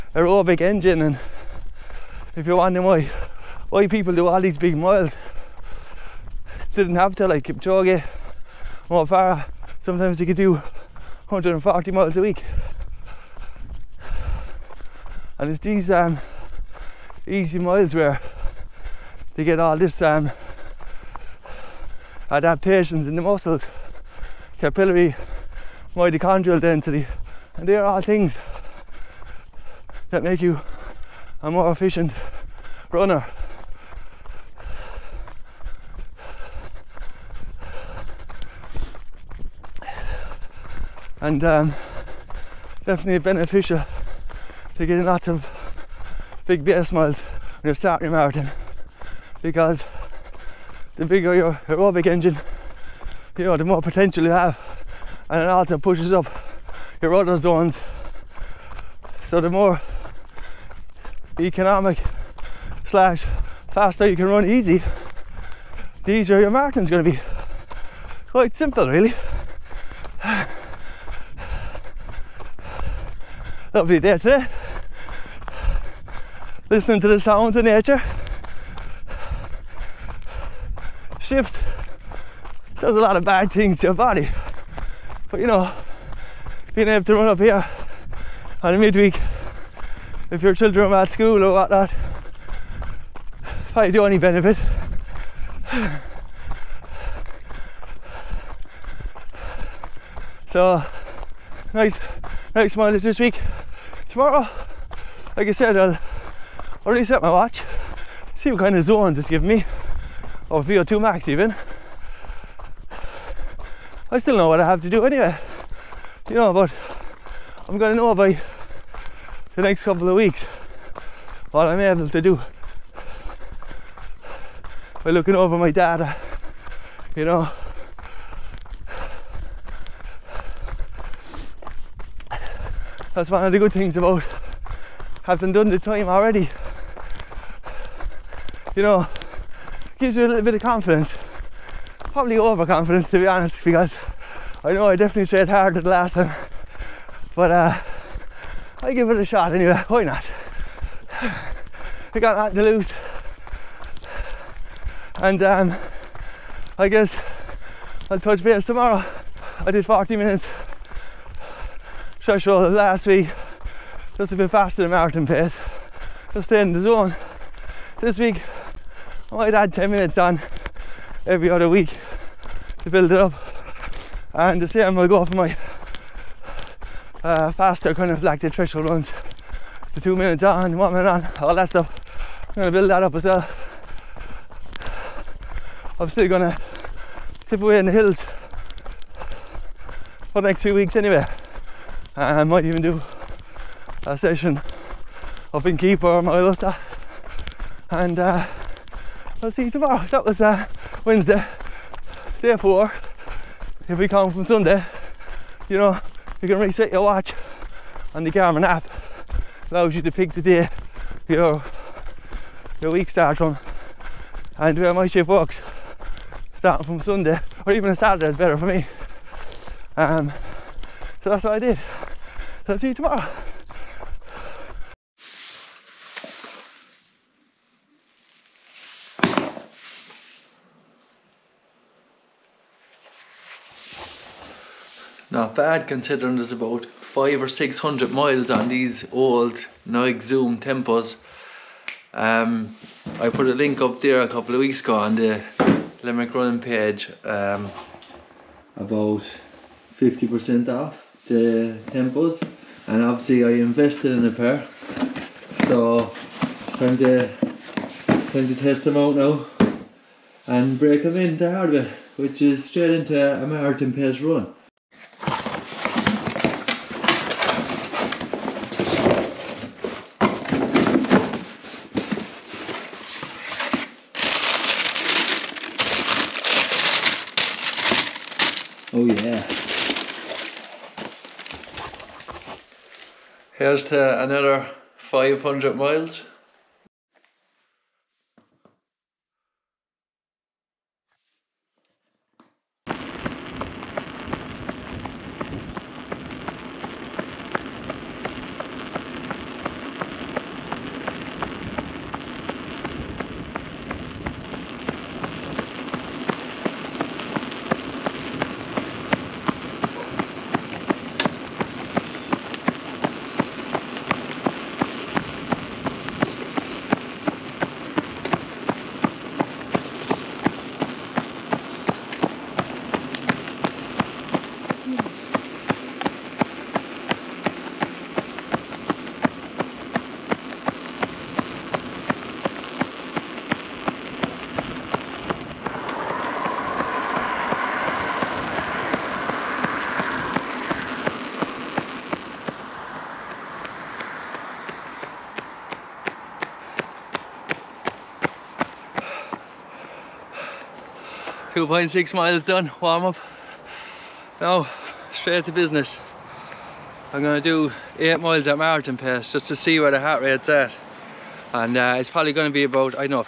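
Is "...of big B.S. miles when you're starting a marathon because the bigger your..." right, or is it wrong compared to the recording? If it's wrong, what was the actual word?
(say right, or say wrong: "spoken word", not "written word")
right.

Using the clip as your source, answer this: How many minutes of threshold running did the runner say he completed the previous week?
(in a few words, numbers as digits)
40 minutes.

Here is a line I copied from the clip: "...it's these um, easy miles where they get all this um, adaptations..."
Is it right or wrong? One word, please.
right.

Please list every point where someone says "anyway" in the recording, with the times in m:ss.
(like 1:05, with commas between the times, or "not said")
1:55, 2:29, 3:10.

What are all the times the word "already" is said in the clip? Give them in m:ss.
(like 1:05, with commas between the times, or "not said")
1:46, 2:16.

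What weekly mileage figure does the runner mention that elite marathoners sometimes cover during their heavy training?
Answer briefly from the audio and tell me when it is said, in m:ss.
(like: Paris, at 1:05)
140 miles, at 0:11.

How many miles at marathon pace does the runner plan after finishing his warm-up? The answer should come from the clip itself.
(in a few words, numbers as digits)
8.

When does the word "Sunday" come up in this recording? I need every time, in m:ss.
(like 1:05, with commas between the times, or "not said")
3:24, 3:36.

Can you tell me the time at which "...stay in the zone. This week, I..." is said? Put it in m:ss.
2:46.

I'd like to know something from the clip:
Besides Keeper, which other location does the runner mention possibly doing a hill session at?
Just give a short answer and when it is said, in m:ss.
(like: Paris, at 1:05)
Moylussa, at 3:16.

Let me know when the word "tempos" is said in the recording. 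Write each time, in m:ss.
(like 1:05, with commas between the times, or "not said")
4:00, 4:11.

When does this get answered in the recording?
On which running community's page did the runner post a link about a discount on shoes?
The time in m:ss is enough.
4:06.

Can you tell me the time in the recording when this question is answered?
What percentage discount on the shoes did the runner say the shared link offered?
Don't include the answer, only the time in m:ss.
4:09.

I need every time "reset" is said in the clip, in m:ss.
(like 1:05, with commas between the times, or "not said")
1:47, 3:26.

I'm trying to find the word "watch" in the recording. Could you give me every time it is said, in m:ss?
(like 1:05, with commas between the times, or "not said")
1:47, 3:27.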